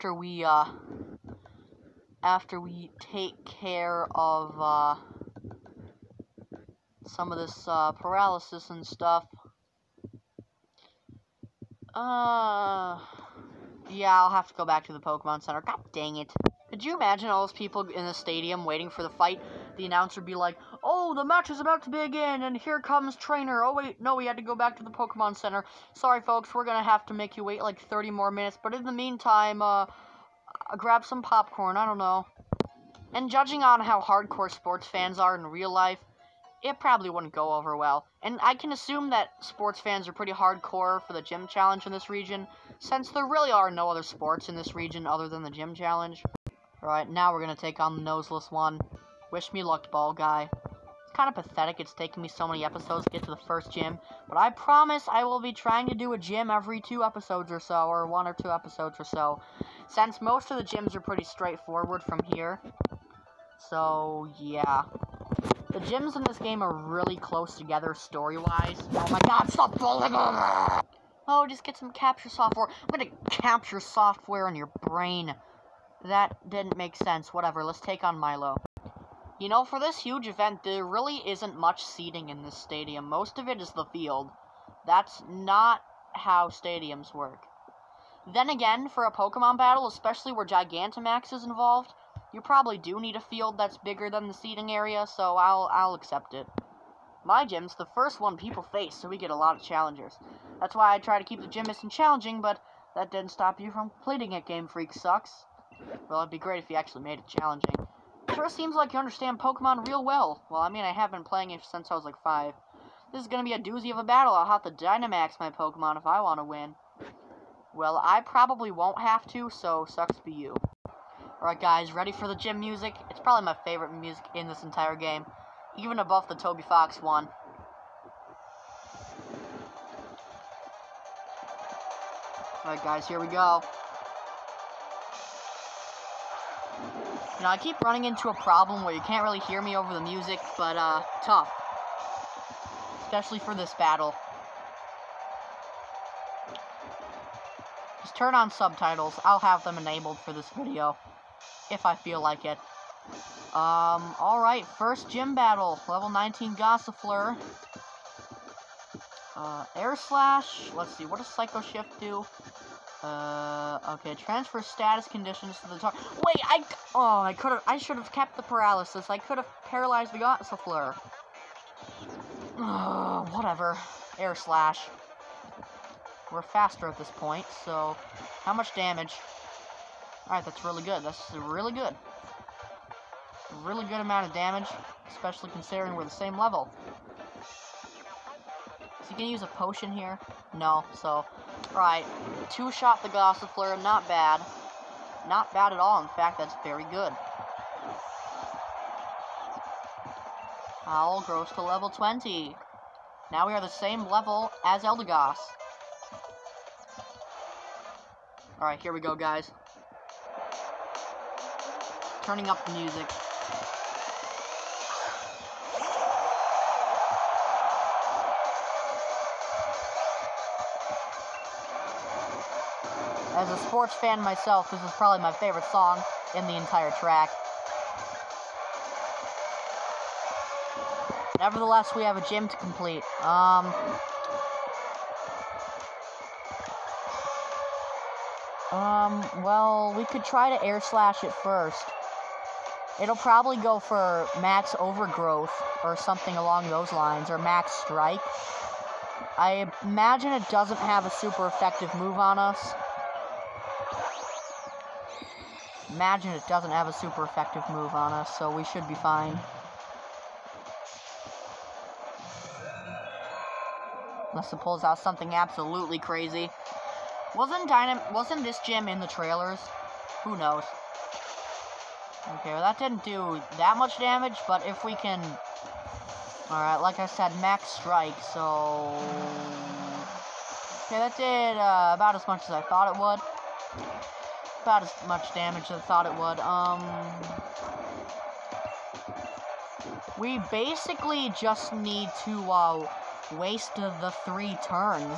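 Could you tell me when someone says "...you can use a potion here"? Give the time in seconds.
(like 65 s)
189 s.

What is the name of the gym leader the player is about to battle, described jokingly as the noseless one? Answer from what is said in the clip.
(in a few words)
Milo.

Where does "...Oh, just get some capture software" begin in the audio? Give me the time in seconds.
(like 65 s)
71 s.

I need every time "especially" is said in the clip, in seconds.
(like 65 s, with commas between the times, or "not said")
89 s, 143 s, 185 s.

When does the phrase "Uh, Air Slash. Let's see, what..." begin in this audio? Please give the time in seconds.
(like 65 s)
159 s.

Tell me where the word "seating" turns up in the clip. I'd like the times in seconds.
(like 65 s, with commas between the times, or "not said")
81 s, 94 s.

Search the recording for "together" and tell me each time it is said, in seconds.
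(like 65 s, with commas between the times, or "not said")
67 s.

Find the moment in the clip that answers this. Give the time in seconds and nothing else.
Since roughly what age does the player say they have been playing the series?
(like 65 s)
112 s.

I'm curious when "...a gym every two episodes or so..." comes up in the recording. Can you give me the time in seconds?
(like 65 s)
56 s.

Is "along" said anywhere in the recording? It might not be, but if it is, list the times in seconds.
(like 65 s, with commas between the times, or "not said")
246 s.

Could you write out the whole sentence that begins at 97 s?
My gym's the first one people face, so we get a lot of challengers.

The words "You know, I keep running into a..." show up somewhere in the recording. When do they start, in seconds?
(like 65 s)
137 s.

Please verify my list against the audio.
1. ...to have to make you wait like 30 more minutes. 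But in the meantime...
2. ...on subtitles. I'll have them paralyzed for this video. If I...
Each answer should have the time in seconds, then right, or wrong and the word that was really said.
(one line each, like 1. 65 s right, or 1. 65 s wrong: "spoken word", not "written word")
1. 26 s right
2. 148 s wrong: "enabled", not "paralyzed".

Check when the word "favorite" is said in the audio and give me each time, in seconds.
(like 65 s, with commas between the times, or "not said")
123 s, 225 s.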